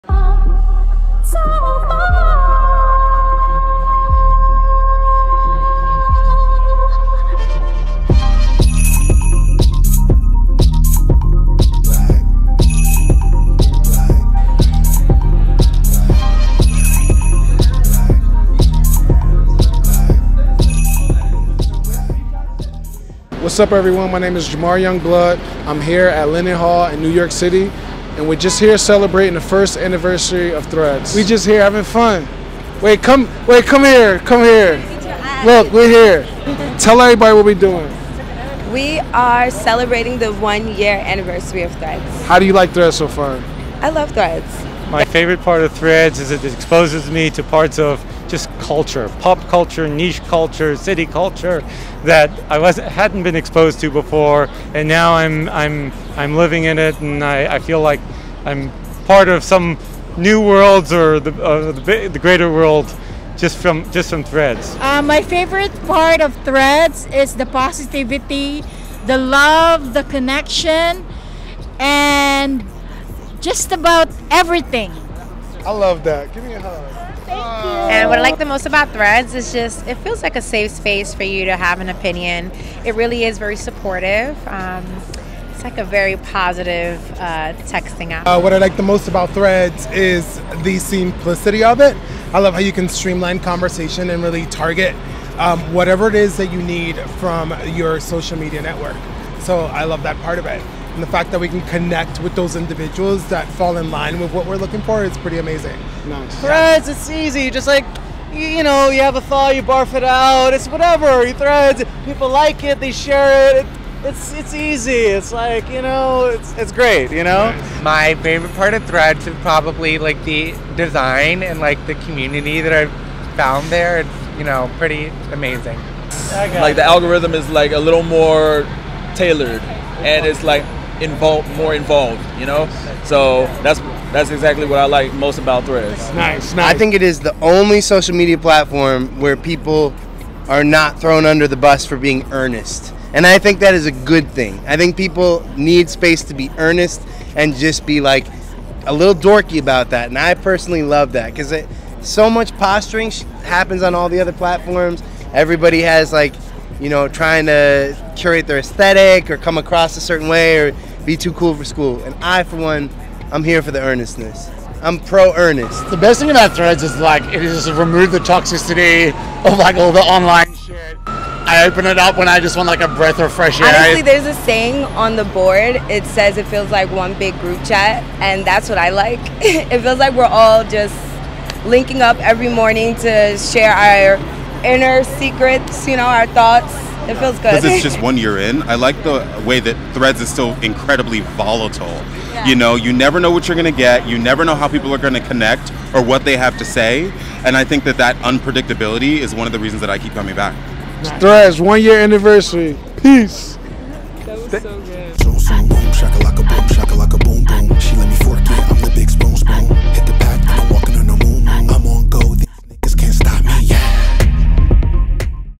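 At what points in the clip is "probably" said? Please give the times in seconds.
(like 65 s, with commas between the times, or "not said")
119 s.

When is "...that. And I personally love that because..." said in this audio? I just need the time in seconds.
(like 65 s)
149 s.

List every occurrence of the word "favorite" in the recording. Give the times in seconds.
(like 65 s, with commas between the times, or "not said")
45 s, 65 s, 118 s.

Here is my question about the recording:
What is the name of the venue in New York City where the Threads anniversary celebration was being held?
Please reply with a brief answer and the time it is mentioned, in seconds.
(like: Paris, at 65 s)
Lennon Hall, at 26 s.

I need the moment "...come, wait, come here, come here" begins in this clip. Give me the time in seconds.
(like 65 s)
33 s.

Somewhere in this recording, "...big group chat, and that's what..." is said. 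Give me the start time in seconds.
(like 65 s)
177 s.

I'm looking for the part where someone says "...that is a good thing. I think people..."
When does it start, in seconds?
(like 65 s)
143 s.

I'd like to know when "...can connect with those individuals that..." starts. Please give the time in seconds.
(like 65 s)
101 s.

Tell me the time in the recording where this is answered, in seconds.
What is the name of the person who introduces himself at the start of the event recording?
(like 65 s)
24 s.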